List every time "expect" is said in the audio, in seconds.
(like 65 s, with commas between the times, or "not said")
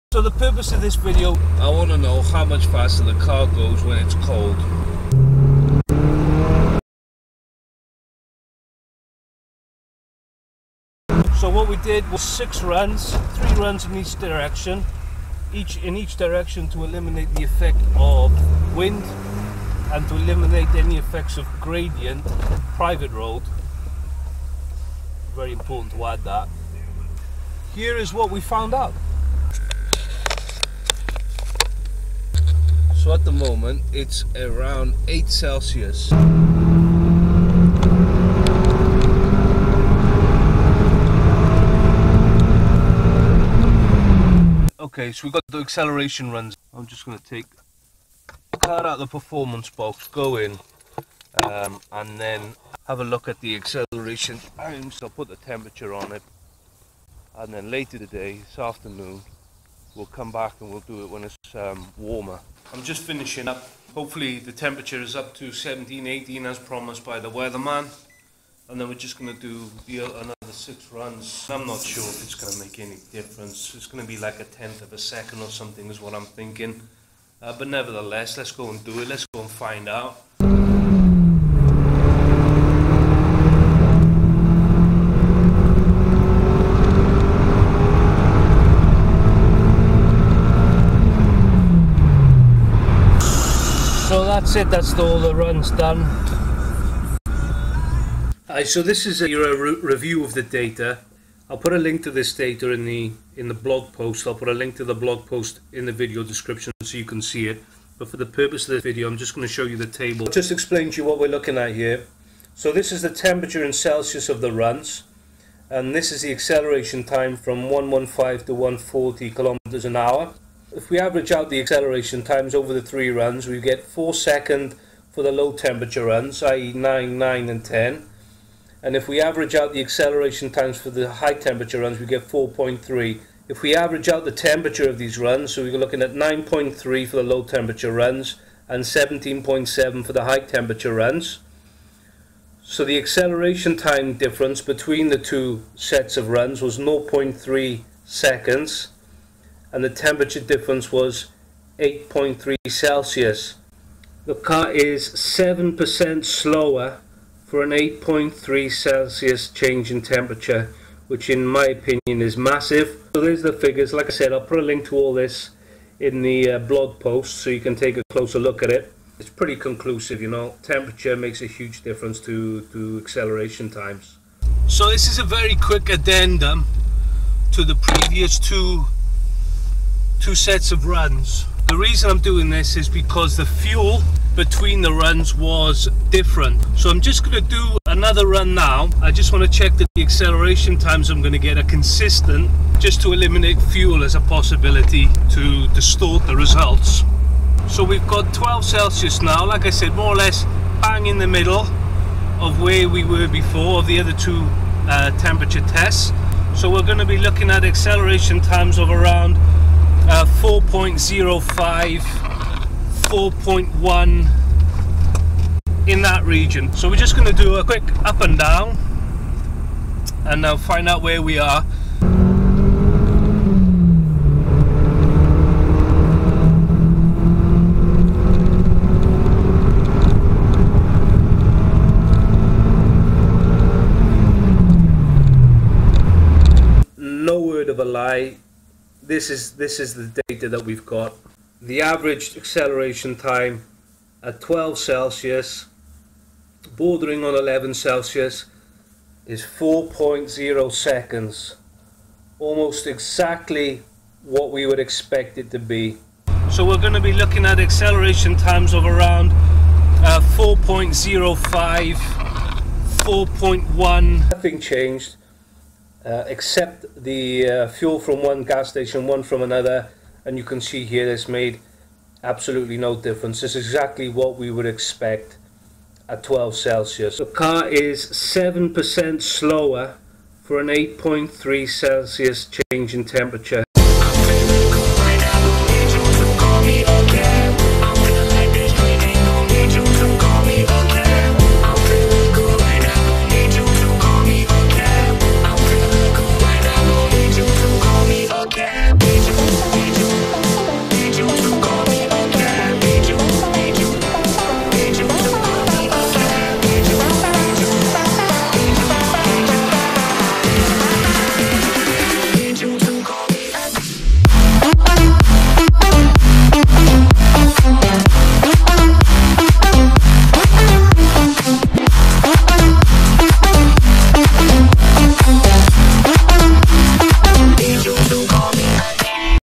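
254 s, 274 s.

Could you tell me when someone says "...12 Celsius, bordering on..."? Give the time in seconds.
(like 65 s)
244 s.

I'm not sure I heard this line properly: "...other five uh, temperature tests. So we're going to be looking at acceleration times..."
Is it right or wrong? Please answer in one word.
wrong.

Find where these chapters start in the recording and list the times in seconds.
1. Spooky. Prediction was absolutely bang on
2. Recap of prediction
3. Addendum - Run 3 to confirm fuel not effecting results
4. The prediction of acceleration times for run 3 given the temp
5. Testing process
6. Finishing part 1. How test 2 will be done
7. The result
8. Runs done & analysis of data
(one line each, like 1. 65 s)
1. 236 s
2. 258 s
3. 177 s
4. 200 s
5. 13 s
6. 46 s
7. 155 s
8. 95 s.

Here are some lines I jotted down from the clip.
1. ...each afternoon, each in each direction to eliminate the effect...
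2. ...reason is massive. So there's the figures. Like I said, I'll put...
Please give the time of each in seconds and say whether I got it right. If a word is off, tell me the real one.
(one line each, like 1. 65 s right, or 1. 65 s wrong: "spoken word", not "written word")
1. 13 s wrong: "direction", not "afternoon"
2. 161 s wrong: "opinion", not "reason".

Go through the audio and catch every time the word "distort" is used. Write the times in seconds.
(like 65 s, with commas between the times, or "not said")
195 s.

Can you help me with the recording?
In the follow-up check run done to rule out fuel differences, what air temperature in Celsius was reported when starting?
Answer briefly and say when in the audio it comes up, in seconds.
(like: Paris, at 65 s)
12, at 198 s.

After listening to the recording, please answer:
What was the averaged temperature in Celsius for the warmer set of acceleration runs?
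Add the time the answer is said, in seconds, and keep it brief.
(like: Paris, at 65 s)
17.7, at 138 s.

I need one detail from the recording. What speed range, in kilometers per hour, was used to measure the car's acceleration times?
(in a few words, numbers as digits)
115 to 140 km/h.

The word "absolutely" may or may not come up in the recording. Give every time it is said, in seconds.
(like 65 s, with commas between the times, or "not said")
272 s.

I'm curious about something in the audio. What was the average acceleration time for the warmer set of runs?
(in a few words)
4.3 seconds.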